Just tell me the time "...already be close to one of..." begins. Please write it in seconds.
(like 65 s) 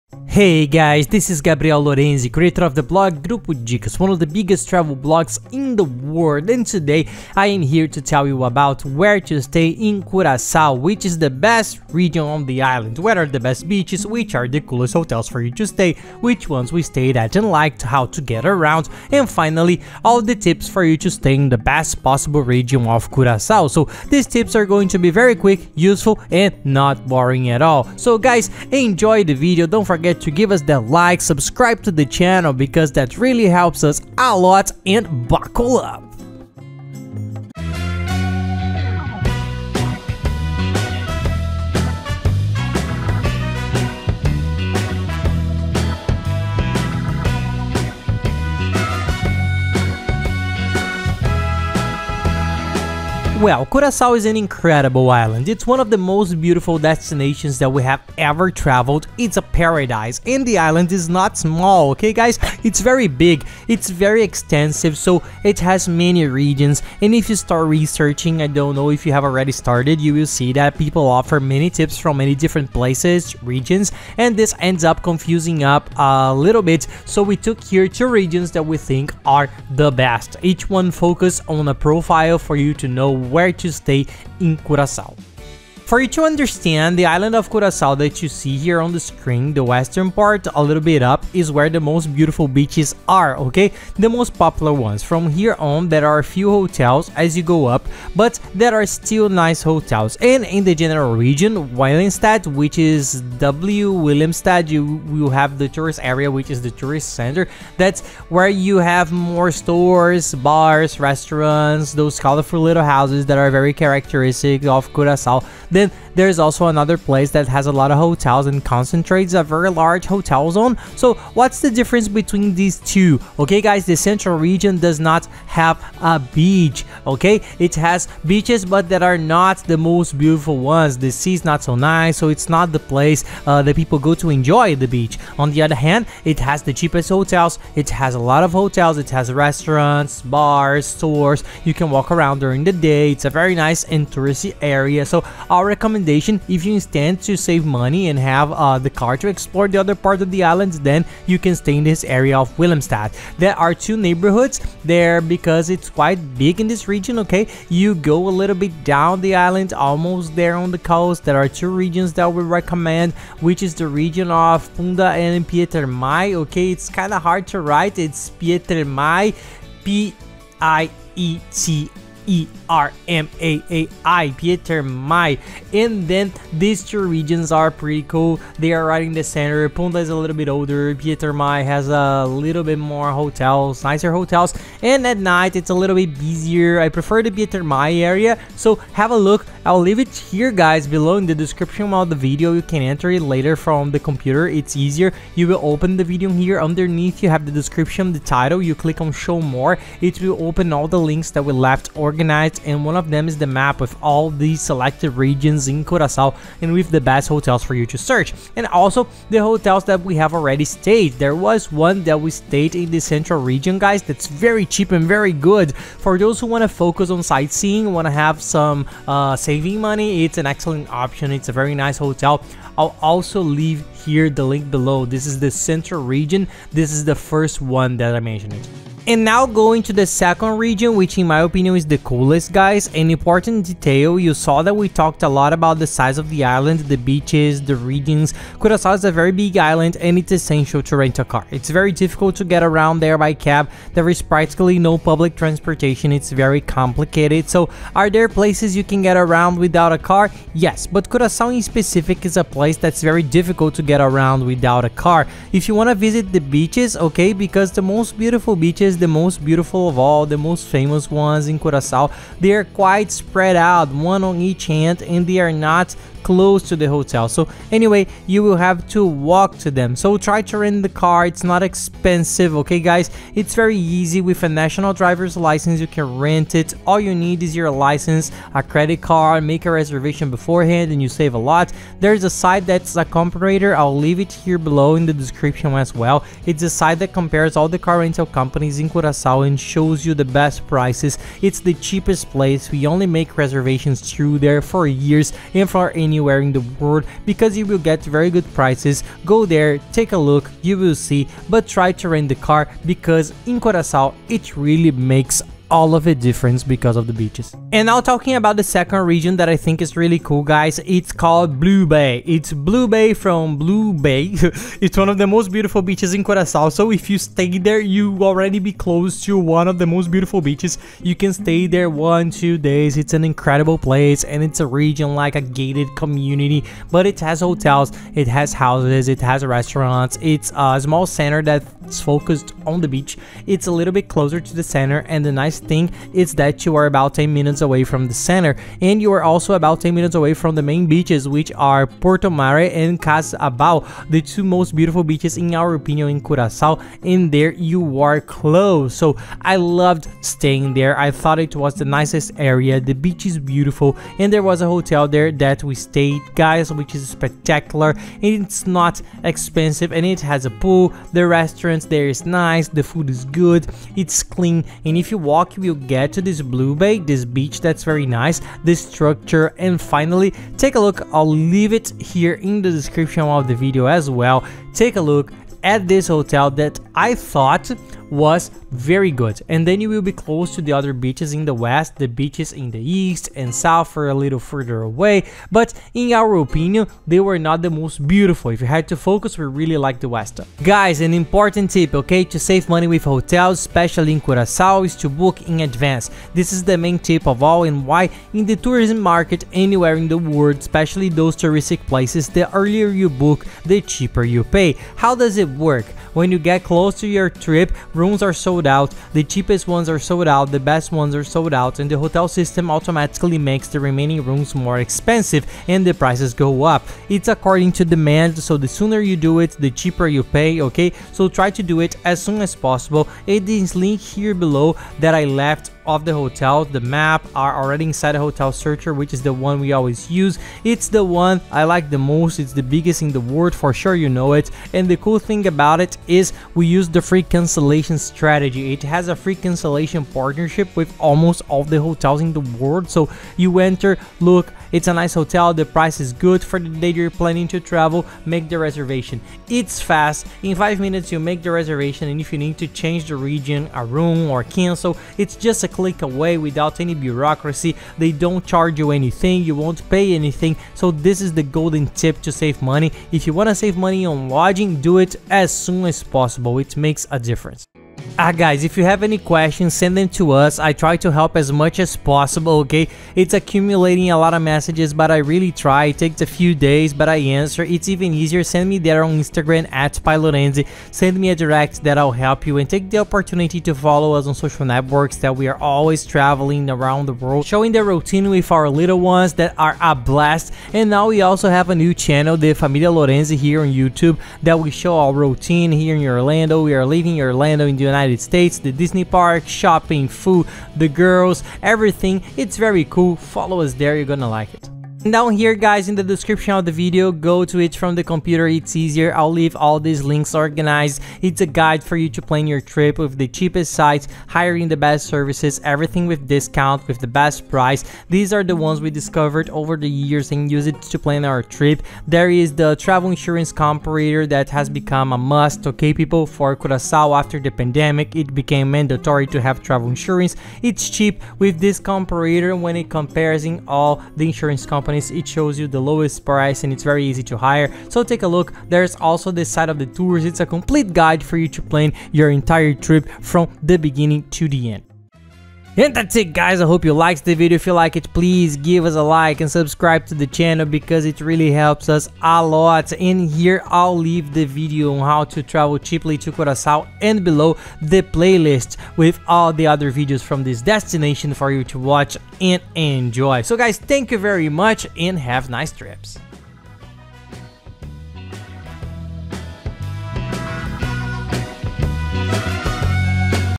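318 s.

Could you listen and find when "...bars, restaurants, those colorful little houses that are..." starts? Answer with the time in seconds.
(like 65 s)
110 s.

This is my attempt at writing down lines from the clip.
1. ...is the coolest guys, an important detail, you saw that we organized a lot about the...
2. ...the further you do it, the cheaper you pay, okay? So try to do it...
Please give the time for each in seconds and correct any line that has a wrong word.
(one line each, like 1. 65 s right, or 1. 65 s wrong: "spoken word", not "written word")
1. 231 s wrong: "talked", not "organized"
2. 418 s wrong: "sooner", not "further".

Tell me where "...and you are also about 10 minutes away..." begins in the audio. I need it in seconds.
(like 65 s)
338 s.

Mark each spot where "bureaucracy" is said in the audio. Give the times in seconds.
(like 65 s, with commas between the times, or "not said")
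456 s.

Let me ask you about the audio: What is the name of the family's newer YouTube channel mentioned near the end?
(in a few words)
Familia Lorenzi.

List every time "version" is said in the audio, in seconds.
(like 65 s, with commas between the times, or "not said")
not said.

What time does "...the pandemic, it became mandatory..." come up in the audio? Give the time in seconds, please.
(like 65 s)
527 s.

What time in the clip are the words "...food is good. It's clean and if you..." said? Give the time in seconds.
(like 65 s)
362 s.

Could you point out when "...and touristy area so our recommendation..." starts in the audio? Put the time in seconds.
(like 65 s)
143 s.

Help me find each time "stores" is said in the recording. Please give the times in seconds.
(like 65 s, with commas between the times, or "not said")
109 s, 140 s.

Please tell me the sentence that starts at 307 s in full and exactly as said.
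And now talking about the second region that I think is really cool guys, it's called Blue Bay.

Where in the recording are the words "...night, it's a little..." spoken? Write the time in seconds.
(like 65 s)
185 s.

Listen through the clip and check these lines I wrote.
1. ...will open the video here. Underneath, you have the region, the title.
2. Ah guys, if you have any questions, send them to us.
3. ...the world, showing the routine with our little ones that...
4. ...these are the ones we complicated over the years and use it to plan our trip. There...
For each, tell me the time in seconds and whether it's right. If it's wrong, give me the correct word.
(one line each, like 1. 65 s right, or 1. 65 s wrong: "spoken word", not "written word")
1. 195 s wrong: "description", not "region"
2. 468 s right
3. 487 s right
4. 518 s wrong: "discovered", not "complicated".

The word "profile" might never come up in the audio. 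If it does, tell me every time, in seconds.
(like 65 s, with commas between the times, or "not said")
81 s.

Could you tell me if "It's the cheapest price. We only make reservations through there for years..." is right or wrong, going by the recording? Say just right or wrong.
wrong.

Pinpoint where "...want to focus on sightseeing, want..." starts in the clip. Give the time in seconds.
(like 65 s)
216 s.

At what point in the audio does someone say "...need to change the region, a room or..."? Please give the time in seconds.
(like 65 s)
452 s.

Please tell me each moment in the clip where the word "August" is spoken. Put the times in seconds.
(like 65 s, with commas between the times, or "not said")
not said.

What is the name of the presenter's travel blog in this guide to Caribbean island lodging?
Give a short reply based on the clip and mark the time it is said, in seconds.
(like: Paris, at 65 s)
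Grupo Dicas, at 3 s.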